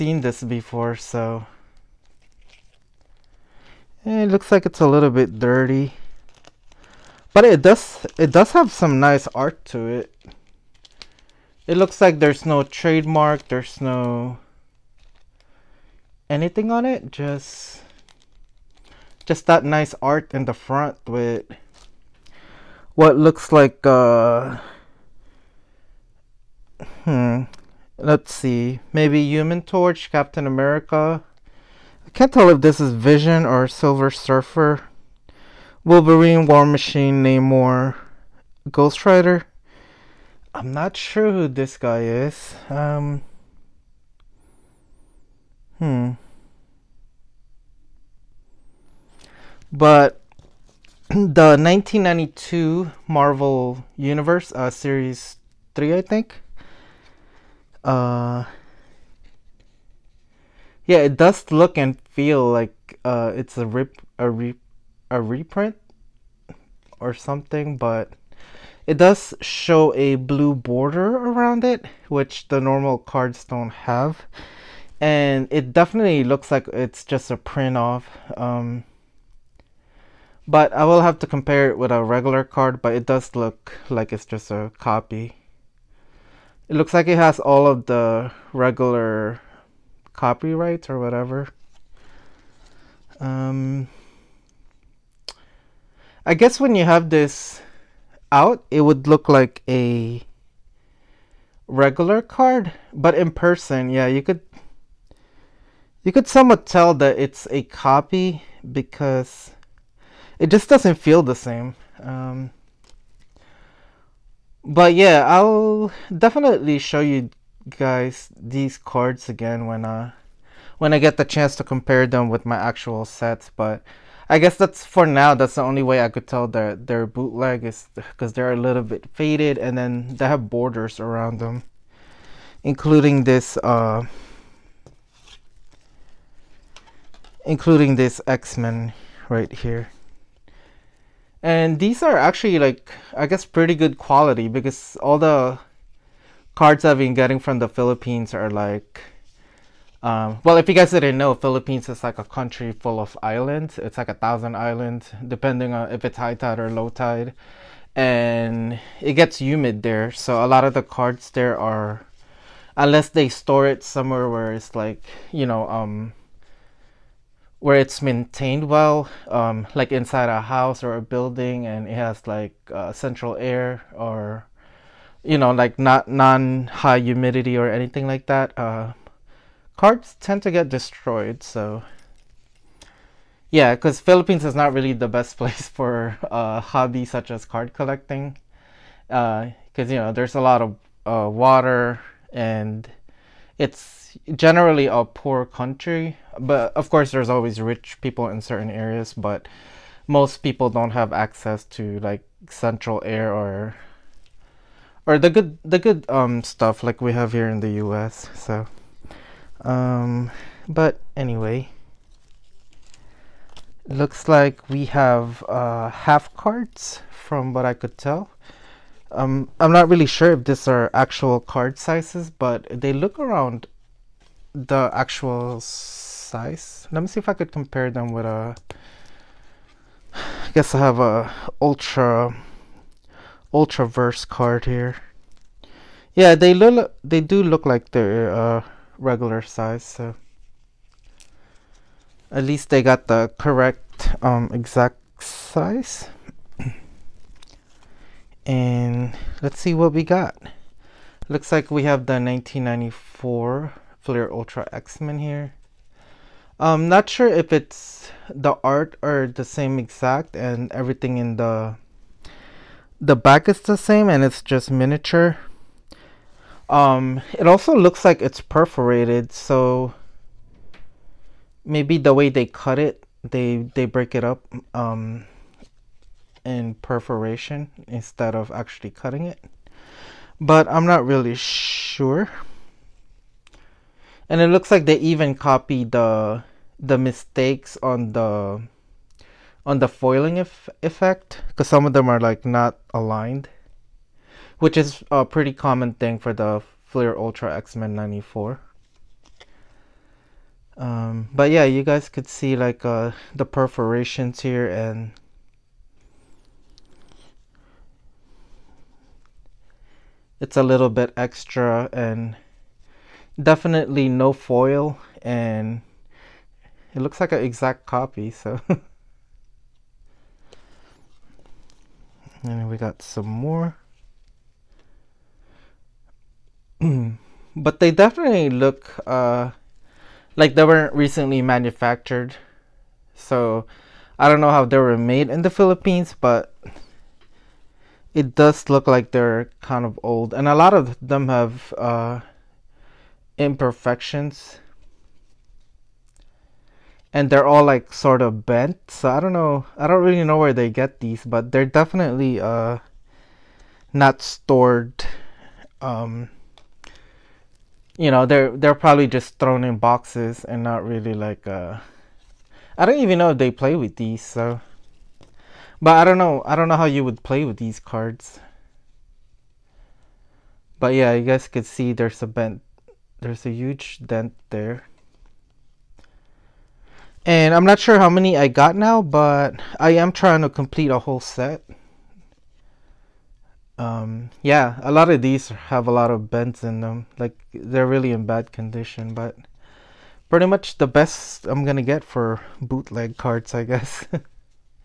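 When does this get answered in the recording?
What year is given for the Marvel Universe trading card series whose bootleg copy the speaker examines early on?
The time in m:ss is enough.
0:51.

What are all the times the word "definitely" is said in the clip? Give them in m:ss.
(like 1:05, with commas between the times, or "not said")
1:15, 1:56, 5:13, 5:27, 5:51.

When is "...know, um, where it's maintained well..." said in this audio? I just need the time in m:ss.
2:45.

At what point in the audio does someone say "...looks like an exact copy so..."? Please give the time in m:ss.
5:16.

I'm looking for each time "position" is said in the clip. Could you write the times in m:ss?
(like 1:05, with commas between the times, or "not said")
not said.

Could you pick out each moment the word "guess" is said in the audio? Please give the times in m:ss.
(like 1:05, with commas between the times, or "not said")
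1:36, 2:04, 2:23, 3:50, 6:33.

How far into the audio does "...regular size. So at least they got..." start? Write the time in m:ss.
3:58.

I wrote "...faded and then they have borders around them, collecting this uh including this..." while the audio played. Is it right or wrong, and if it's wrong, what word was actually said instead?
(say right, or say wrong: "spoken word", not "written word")
wrong: "including", not "collecting".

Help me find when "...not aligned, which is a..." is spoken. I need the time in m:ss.
4:52.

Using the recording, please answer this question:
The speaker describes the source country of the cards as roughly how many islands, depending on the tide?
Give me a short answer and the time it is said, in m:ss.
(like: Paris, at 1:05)
1000, at 2:34.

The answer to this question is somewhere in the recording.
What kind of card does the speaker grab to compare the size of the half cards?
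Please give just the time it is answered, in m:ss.
3:53.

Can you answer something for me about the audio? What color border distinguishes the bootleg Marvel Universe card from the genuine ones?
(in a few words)
Blue.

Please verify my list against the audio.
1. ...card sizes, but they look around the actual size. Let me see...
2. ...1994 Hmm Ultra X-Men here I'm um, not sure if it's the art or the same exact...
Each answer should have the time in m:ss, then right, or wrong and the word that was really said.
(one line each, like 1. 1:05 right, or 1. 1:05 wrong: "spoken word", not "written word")
1. 3:41 right
2. 4:12 wrong: "Flair", not "Hmm".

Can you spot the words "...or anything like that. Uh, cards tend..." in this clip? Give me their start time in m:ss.
2:57.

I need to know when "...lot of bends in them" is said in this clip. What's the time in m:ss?
6:25.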